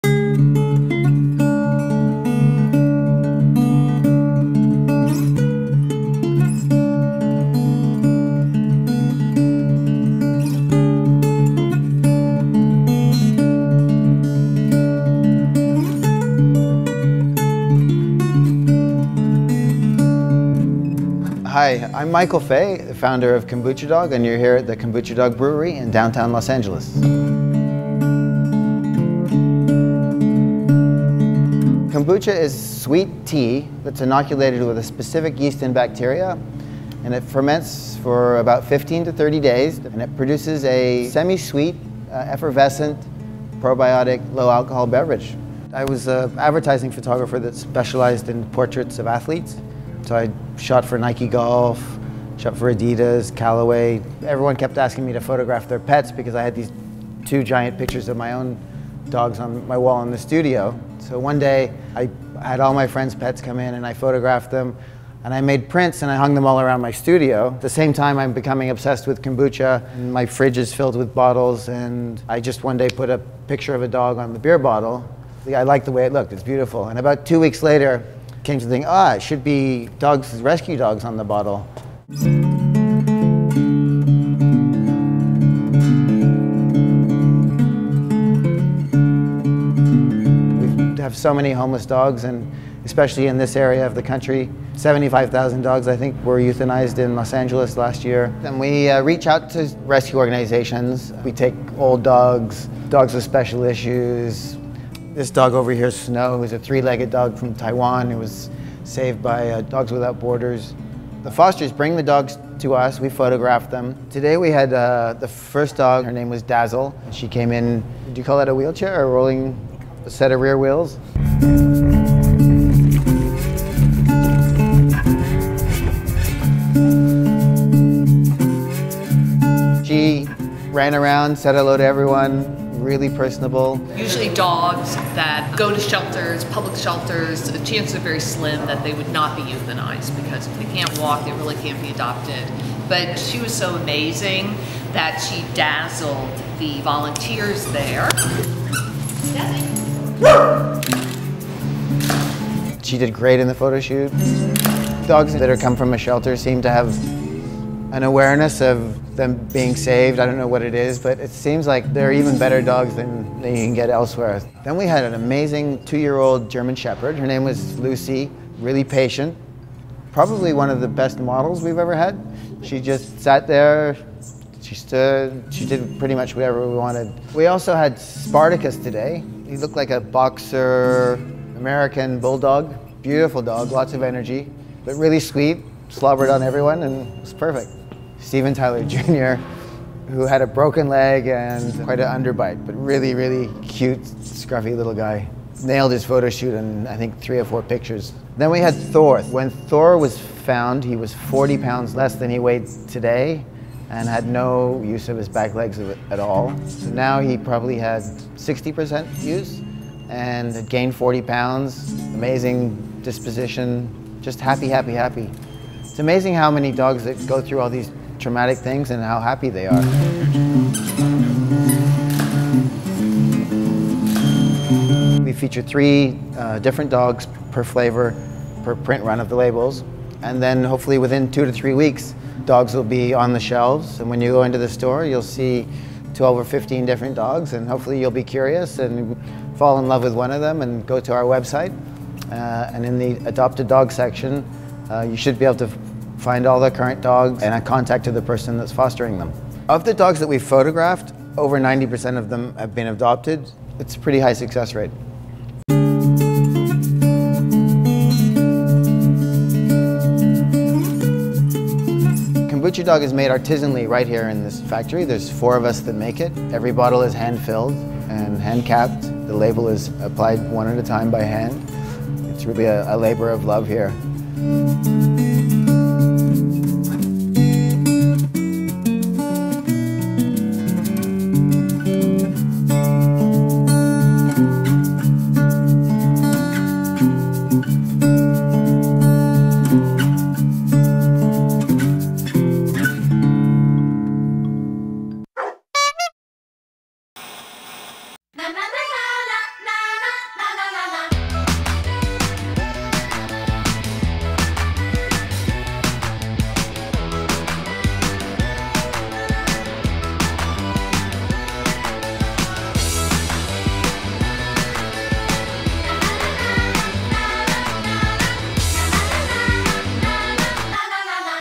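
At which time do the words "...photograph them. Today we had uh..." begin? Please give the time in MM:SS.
01:53.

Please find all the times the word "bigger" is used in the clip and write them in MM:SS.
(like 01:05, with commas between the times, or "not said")
not said.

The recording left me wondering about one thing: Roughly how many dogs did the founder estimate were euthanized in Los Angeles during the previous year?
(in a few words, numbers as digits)
75,000.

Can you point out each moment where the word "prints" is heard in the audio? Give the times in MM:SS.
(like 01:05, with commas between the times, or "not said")
01:05, 03:48.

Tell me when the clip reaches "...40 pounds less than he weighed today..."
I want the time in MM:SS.
03:21.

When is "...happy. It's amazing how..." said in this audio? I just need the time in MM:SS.
03:34.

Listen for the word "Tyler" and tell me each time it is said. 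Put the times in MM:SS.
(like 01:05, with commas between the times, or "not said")
03:08.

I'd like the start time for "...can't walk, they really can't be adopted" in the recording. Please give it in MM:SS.
02:20.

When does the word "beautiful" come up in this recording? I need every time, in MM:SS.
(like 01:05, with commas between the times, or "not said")
01:16, 03:03.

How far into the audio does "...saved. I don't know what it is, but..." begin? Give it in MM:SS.
02:39.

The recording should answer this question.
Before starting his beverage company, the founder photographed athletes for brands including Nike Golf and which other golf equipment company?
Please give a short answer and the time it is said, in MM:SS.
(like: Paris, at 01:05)
Callaway, at 00:53.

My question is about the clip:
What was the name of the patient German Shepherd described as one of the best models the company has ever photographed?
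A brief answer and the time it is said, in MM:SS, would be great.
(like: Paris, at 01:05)
Lucy, at 02:47.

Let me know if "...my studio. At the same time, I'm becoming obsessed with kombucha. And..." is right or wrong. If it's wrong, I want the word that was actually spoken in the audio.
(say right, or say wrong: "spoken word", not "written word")
right.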